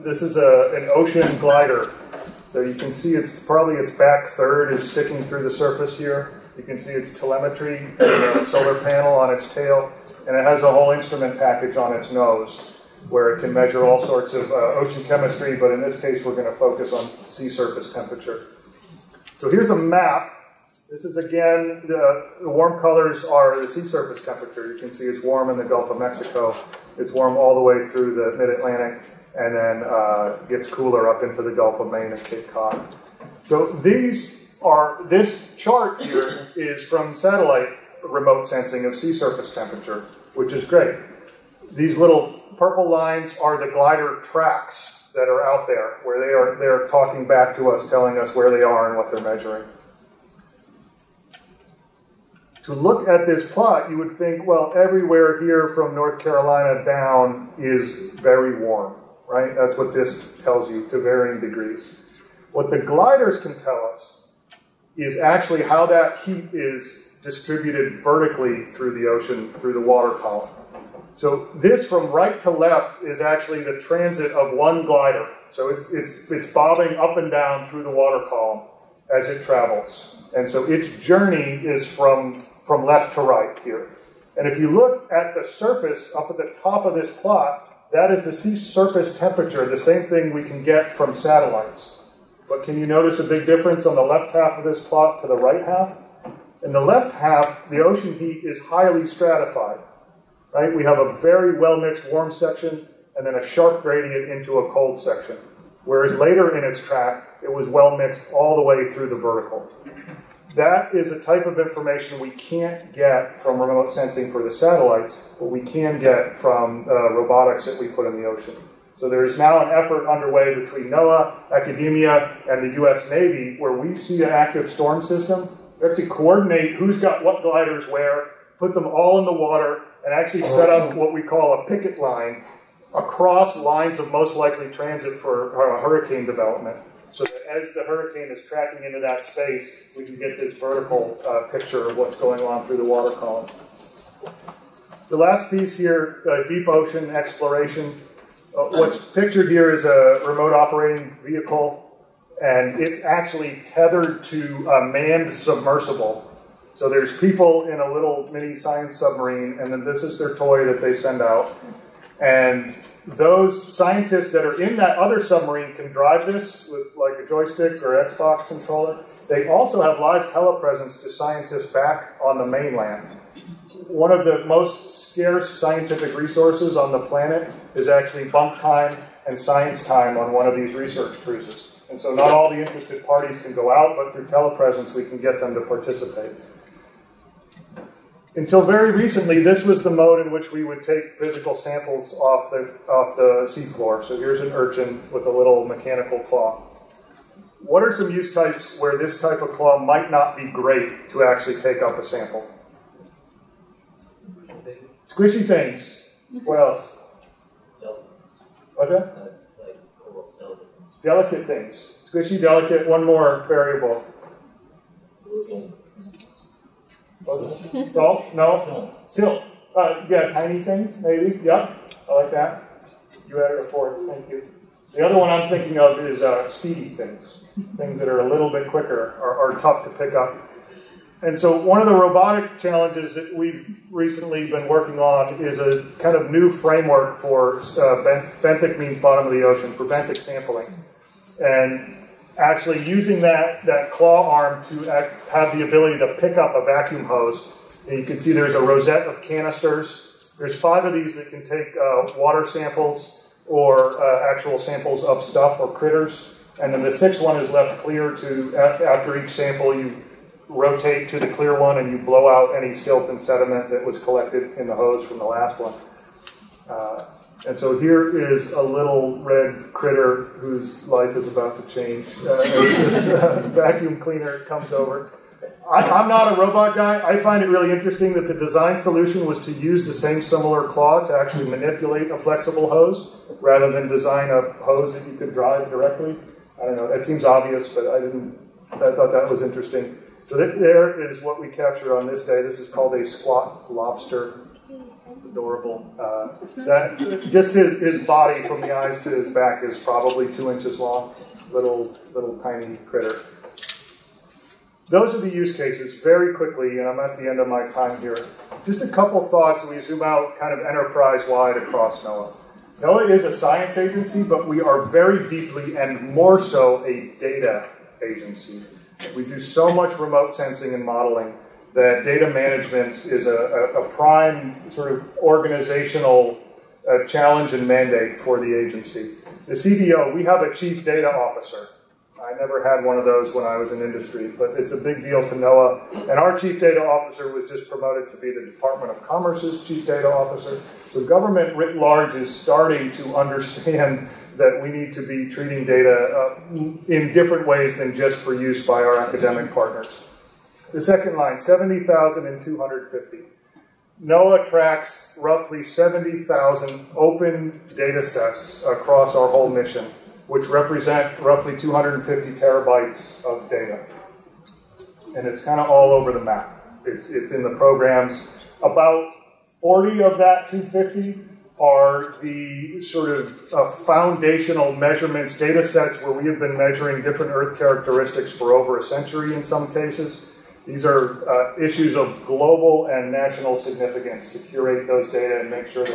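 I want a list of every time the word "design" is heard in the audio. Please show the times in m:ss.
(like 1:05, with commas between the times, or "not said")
4:38, 4:43.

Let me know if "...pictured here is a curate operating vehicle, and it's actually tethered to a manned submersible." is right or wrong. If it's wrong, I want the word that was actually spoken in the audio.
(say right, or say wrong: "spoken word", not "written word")
wrong: "remote", not "curate".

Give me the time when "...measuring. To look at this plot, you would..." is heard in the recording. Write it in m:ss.
0:49.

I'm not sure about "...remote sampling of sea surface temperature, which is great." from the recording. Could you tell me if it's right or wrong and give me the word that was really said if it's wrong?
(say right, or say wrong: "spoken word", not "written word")
wrong: "sensing", not "sampling".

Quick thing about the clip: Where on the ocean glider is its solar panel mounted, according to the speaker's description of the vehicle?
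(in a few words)
On its tail.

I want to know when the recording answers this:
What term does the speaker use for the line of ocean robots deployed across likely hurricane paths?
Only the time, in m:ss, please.
2:11.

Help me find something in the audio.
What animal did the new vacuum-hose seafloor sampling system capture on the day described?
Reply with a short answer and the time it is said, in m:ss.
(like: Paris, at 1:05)
Squat lobster, at 4:53.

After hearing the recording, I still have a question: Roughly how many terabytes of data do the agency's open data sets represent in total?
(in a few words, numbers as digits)
250 terabytes.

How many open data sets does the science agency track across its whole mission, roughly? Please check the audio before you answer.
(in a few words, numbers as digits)
70,000.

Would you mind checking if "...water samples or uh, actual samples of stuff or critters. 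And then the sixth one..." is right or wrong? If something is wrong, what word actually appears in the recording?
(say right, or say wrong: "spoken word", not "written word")
right.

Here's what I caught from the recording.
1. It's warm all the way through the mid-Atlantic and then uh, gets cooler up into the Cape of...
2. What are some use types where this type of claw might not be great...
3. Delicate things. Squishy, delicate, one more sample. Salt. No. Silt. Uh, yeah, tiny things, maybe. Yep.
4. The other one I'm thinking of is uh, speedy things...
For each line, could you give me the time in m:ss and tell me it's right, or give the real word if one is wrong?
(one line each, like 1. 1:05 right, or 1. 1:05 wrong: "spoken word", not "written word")
1. 0:26 wrong: "Gulf", not "Cape"
2. 3:17 right
3. 3:31 wrong: "variable", not "sample"
4. 3:44 right.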